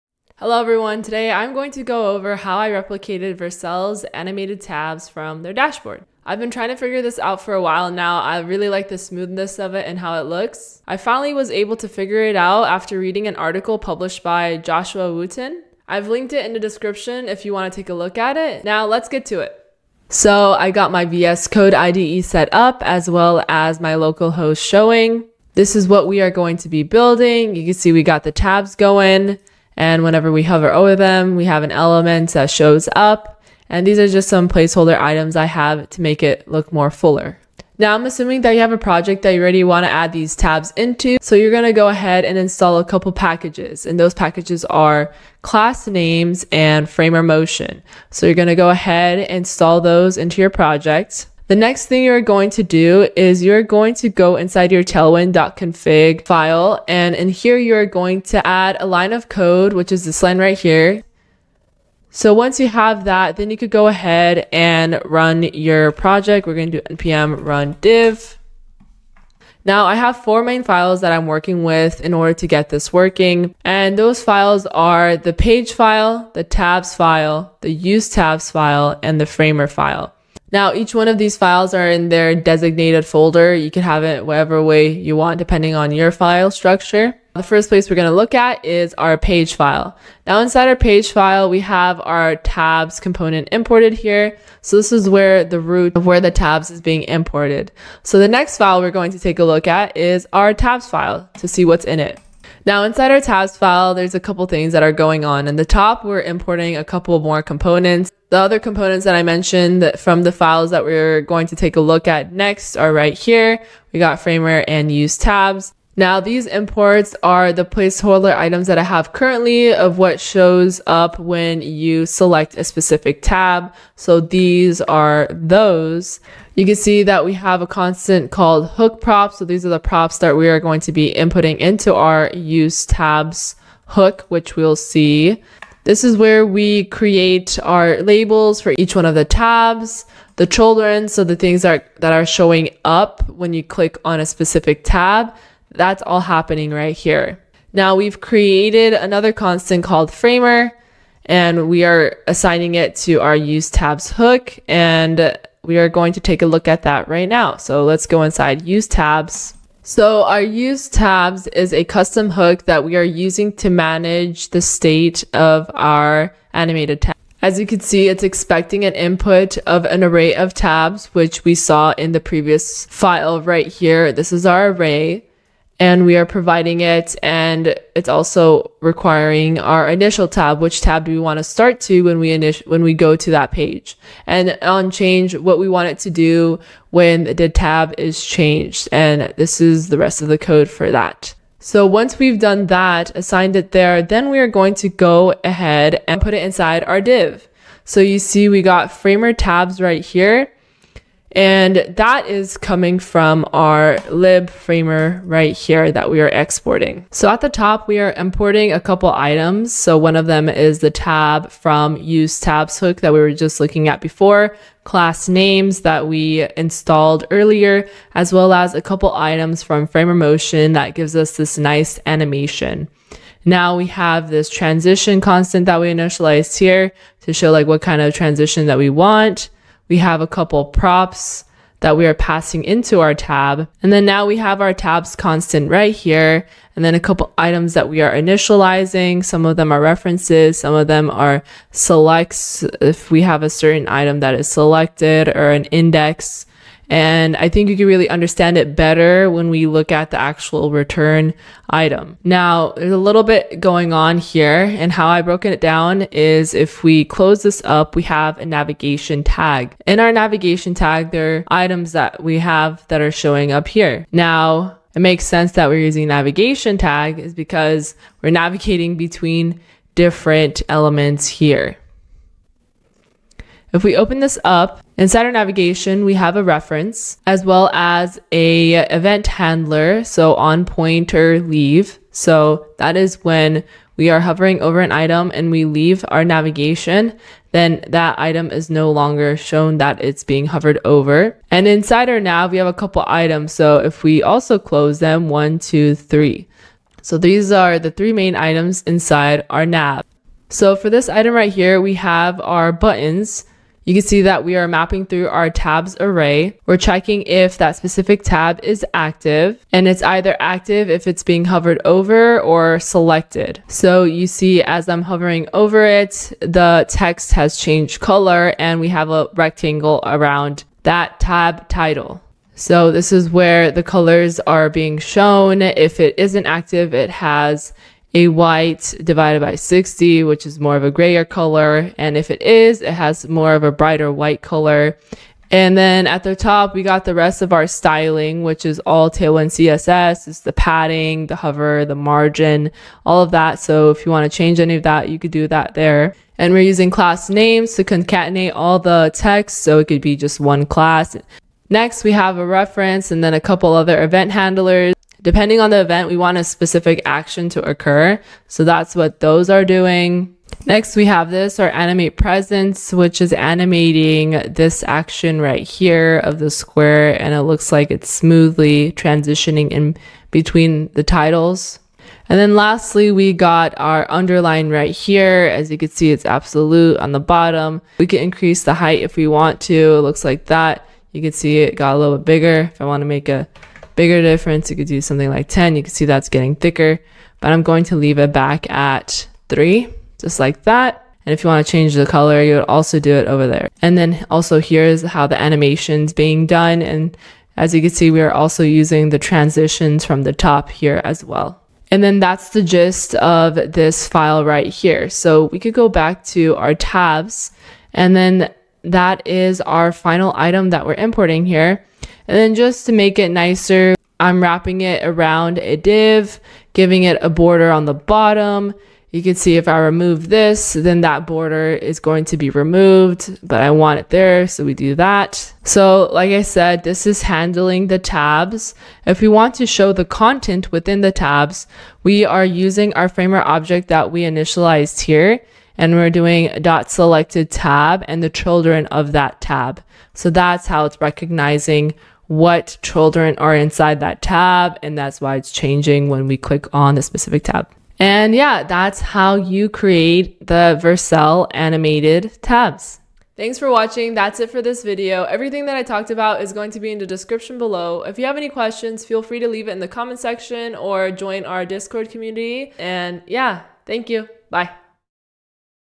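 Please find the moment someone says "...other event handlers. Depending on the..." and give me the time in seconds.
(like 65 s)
353 s.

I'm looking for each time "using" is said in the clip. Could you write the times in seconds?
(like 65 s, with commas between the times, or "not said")
163 s, 265 s, 346 s, 398 s, 432 s.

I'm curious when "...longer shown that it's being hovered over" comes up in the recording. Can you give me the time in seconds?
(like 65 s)
288 s.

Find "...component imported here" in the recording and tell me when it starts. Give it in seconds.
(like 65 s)
92 s.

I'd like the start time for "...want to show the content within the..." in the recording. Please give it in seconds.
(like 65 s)
429 s.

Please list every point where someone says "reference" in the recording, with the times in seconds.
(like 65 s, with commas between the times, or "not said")
239 s, 276 s, 352 s.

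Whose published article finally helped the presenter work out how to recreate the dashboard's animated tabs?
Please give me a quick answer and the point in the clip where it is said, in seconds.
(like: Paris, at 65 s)
Joshua Wootonn, at 14 s.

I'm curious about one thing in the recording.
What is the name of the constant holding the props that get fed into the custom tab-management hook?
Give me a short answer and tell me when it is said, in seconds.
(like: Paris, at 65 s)
hook props, at 128 s.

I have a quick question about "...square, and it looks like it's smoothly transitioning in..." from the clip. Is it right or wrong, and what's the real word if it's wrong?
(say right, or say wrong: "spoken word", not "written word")
right.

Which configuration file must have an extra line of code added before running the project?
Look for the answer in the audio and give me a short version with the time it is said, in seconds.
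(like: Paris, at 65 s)
tailwind.config, at 54 s.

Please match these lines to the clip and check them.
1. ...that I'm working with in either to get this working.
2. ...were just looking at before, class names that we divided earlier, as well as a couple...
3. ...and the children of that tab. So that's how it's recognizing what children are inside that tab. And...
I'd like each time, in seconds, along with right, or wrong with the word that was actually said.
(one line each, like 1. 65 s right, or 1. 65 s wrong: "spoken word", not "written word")
1. 71 s wrong: "order", not "either"
2. 213 s wrong: "installed", not "divided"
3. 438 s right.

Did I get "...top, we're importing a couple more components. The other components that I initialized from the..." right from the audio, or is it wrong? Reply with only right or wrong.
wrong.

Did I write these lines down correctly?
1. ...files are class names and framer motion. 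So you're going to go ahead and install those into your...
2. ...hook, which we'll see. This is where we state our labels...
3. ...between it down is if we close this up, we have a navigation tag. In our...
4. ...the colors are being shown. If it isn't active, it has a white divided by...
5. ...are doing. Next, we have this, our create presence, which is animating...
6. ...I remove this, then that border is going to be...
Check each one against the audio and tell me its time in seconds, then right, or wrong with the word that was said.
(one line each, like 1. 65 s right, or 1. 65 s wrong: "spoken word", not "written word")
1. 44 s wrong: "packages", not "files"
2. 133 s wrong: "create", not "state"
3. 255 s wrong: "broken", not "between"
4. 323 s right
5. 359 s wrong: "animate", not "create"
6. 419 s right.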